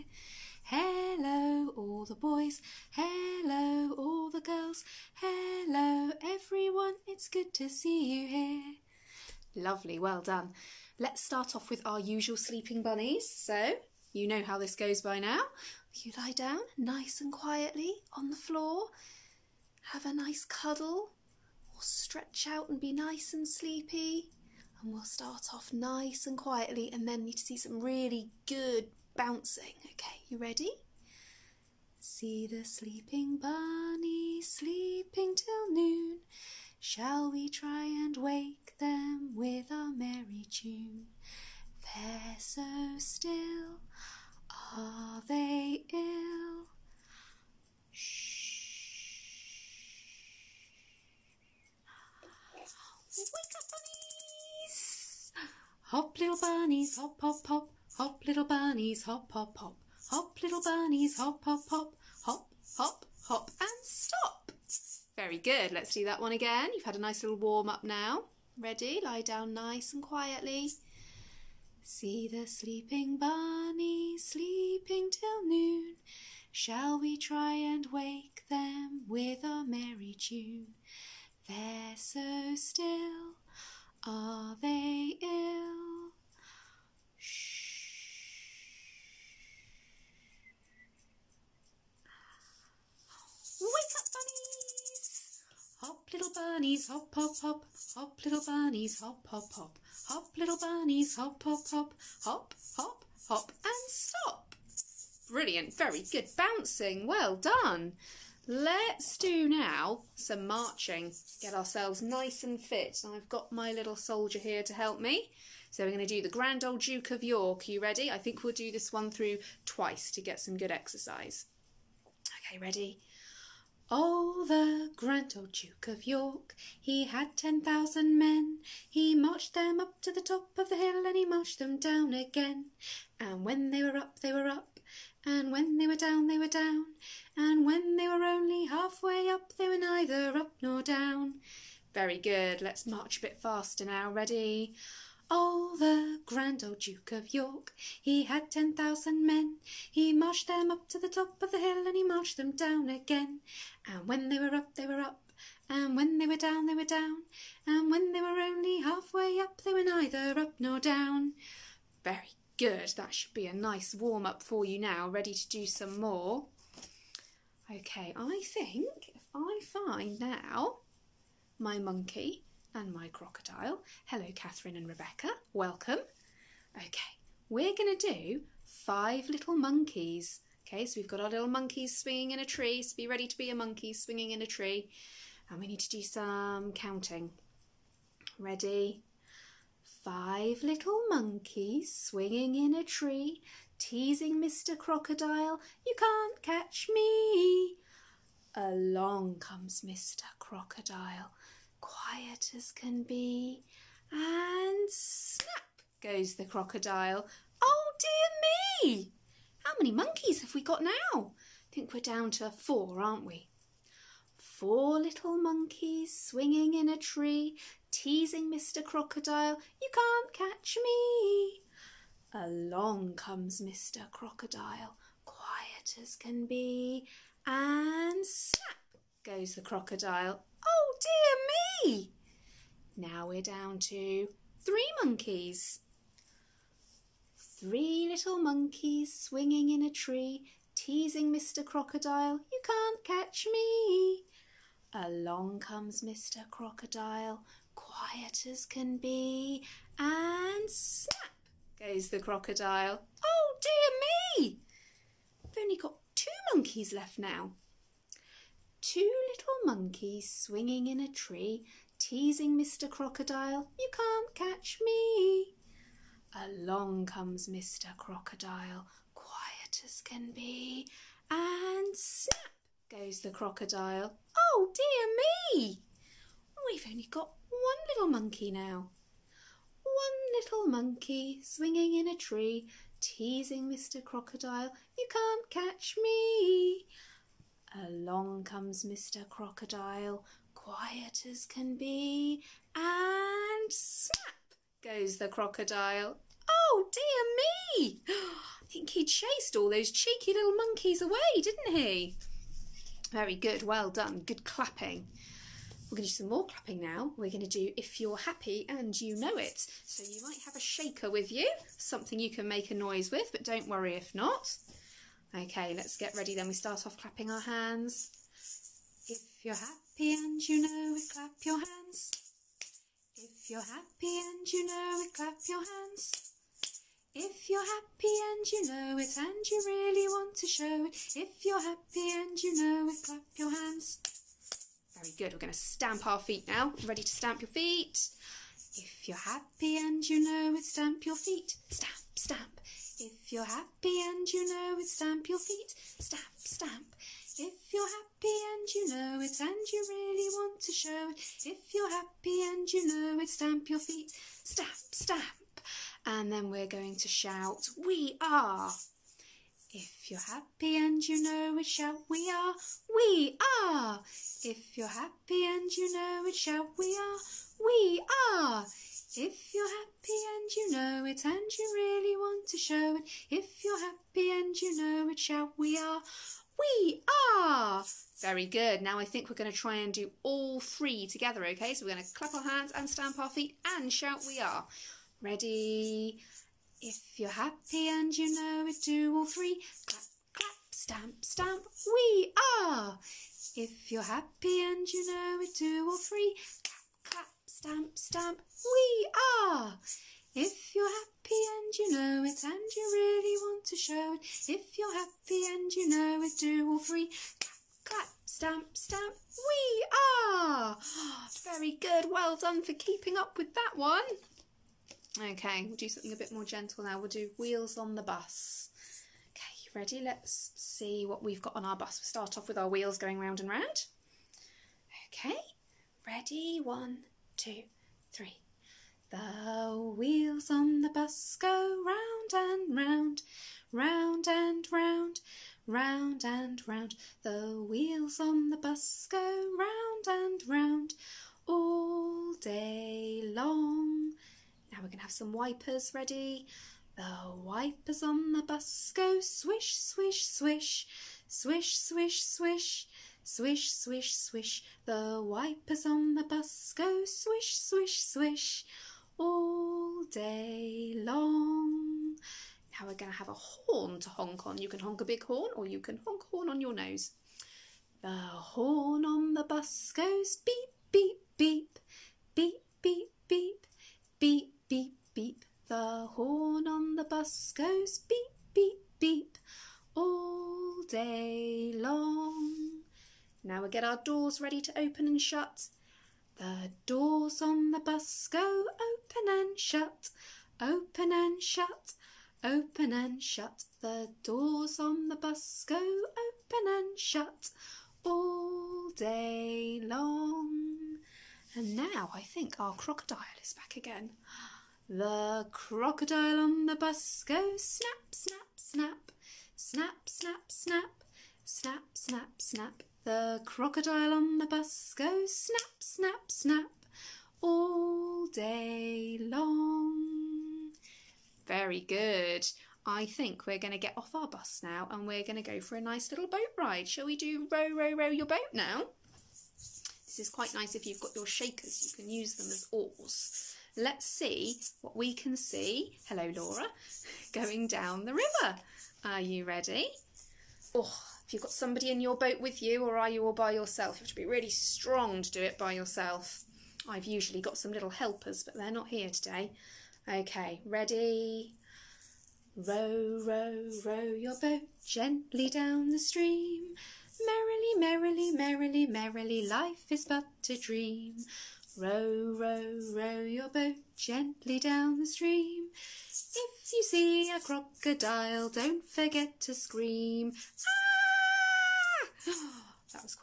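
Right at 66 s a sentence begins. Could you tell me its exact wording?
You've had a nice little warm up now.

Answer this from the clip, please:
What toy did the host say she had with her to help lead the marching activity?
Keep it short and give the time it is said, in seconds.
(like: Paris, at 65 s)
little soldier, at 113 s.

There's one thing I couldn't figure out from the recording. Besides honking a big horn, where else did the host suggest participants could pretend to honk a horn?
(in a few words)
your nose.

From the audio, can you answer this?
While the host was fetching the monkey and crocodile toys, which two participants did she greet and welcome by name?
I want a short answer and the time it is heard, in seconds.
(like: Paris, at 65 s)
Catherine and Rebecca, at 174 s.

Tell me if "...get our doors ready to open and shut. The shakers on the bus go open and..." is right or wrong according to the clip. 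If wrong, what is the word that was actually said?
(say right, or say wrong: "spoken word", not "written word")
wrong: "doors", not "shakers".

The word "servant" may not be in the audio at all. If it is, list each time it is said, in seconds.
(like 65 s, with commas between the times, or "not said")
not said.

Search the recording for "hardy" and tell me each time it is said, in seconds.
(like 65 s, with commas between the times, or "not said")
not said.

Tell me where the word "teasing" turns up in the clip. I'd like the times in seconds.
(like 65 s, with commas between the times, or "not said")
193 s, 217 s, 240 s, 261 s, 282 s.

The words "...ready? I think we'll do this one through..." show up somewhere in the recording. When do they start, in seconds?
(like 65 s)
117 s.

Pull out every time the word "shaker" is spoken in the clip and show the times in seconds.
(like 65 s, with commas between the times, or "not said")
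310 s, 531 s.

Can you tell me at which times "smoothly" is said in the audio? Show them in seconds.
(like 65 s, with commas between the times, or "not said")
not said.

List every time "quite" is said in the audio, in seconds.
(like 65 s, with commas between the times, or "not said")
530 s.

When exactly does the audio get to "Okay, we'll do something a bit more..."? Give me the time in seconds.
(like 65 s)
415 s.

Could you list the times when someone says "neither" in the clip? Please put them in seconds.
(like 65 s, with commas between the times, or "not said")
139 s, 159 s.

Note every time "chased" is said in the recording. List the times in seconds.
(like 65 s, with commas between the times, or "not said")
299 s.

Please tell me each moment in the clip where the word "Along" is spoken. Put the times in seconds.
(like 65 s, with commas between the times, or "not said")
198 s, 222 s, 244 s, 266 s, 288 s.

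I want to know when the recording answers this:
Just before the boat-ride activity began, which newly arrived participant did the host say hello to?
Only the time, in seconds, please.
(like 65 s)
536 s.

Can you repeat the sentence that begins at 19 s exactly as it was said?
Have a nice cuddle stretch out and be nice and sleepy.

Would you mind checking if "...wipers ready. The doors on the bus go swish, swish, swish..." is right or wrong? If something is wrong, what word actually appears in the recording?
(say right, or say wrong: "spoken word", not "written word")
wrong: "wipers", not "doors".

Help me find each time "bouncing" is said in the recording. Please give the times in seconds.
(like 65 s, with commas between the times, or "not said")
29 s, 106 s.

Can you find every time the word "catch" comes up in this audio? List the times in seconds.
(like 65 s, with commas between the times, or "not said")
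196 s, 220 s, 243 s, 264 s, 285 s.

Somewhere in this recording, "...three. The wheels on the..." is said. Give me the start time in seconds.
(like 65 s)
428 s.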